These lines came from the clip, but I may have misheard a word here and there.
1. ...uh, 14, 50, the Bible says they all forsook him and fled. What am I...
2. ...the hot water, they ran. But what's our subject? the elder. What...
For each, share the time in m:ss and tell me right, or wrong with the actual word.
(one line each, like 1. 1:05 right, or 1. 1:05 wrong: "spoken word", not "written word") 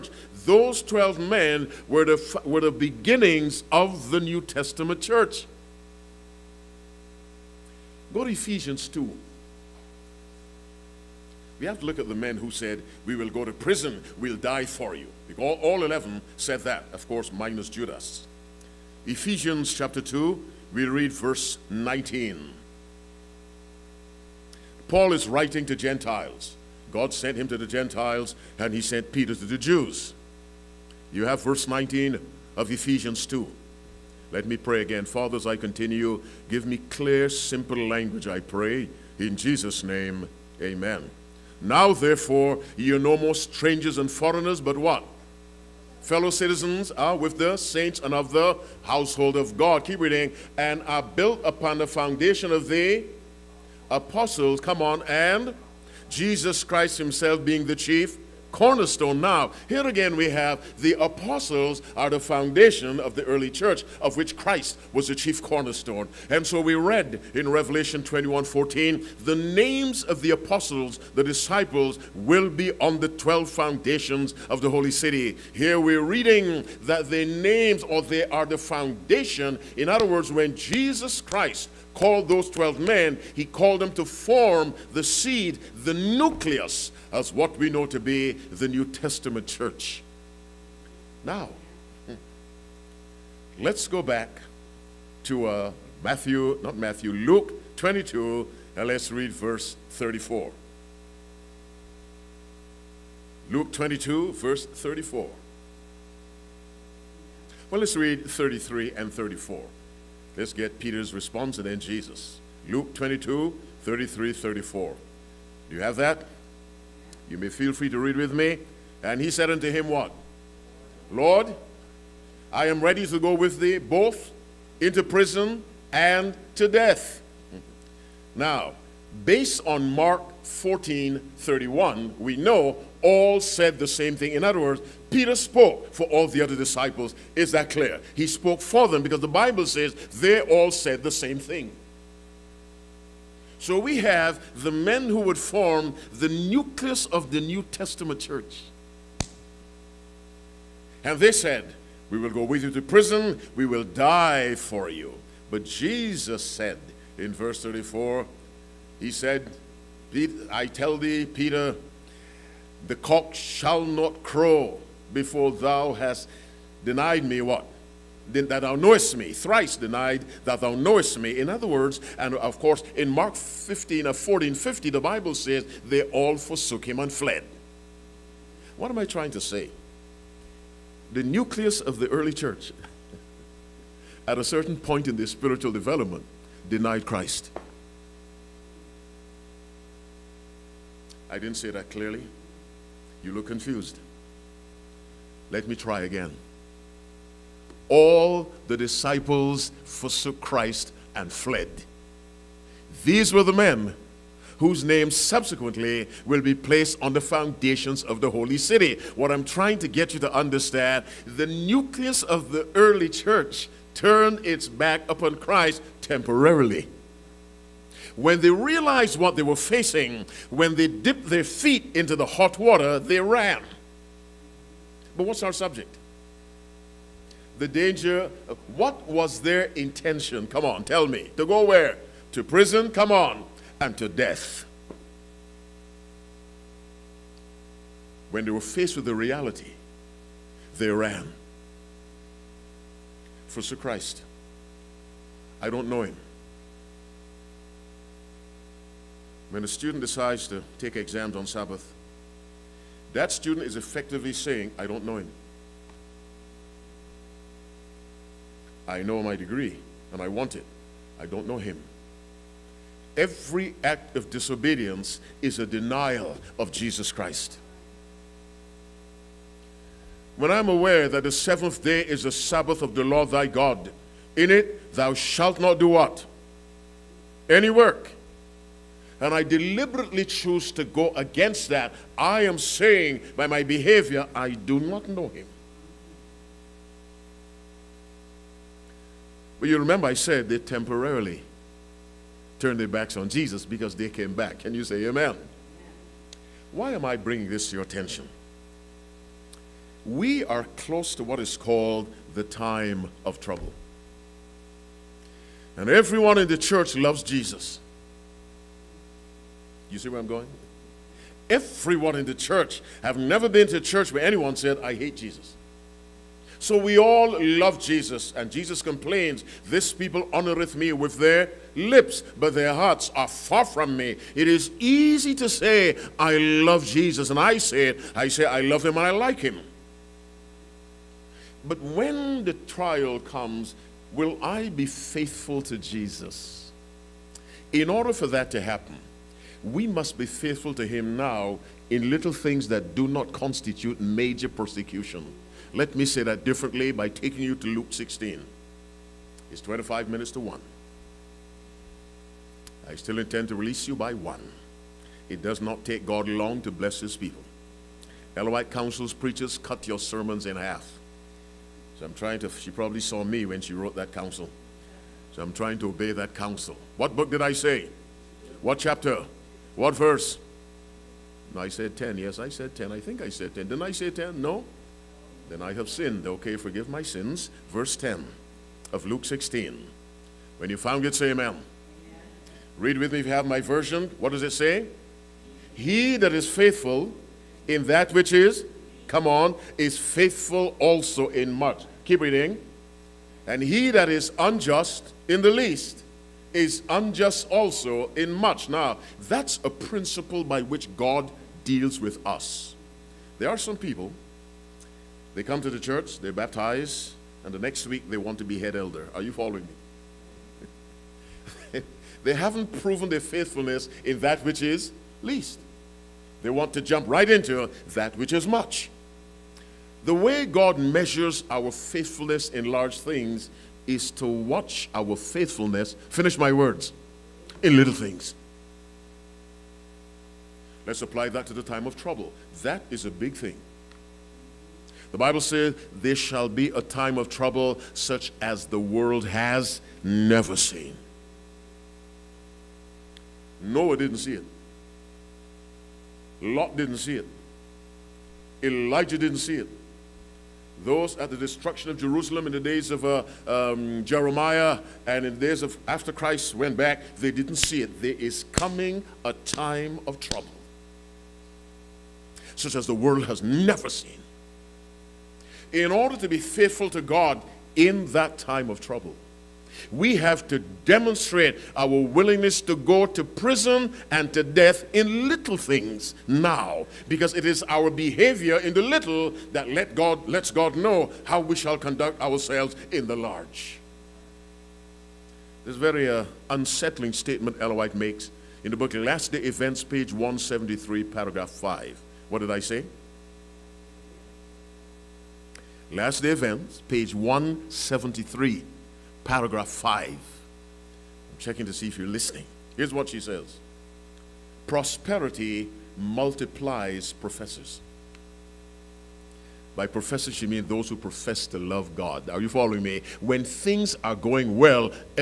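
1. 2:54 right
2. 3:42 wrong: "danger", not "elder".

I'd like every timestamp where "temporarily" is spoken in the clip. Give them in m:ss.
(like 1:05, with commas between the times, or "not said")
3:36, 4:50.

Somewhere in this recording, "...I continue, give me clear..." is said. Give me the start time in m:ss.
0:35.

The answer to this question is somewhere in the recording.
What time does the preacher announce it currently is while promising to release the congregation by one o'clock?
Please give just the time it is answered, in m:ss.
5:49.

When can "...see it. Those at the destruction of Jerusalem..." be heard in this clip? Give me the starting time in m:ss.
7:29.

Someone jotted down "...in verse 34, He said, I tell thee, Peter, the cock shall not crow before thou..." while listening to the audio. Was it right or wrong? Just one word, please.
right.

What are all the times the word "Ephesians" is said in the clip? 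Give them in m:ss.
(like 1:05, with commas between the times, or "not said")
0:08, 0:19, 0:32.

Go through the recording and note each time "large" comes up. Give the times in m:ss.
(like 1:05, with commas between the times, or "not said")
7:02, 8:03.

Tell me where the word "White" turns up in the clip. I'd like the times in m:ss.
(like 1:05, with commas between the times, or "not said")
5:58, 8:07.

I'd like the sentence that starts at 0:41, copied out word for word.
Now, therefore, ye are no more strangers and foreigners, but what?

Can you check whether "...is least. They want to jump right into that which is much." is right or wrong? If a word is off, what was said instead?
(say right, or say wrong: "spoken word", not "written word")
right.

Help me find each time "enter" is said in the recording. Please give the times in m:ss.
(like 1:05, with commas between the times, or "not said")
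not said.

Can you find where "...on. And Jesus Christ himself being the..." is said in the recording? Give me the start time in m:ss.
0:54.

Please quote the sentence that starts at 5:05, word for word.
And everyone in the church loves Jesus.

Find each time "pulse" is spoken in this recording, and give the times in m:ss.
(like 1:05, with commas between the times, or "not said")
not said.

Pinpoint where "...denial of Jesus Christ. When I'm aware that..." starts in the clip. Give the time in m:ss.
4:25.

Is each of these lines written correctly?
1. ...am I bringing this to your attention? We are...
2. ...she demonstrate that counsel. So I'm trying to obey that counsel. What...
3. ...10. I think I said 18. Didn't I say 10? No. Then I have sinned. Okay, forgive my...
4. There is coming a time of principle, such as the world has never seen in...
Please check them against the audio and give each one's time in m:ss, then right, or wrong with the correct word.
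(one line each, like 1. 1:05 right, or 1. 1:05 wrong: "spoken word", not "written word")
1. 4:56 right
2. 6:03 wrong: "wrote", not "demonstrate"
3. 6:12 wrong: "10", not "18"
4. 7:38 wrong: "trouble", not "principle".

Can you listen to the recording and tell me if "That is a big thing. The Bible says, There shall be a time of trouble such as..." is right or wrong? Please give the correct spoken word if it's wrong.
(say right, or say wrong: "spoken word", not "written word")
right.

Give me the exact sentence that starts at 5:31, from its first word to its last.
But when the trial comes, will I be faithful to Jesus?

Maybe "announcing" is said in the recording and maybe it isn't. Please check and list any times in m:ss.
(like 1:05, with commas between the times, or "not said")
not said.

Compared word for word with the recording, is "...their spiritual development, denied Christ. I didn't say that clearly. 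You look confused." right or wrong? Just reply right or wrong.
right.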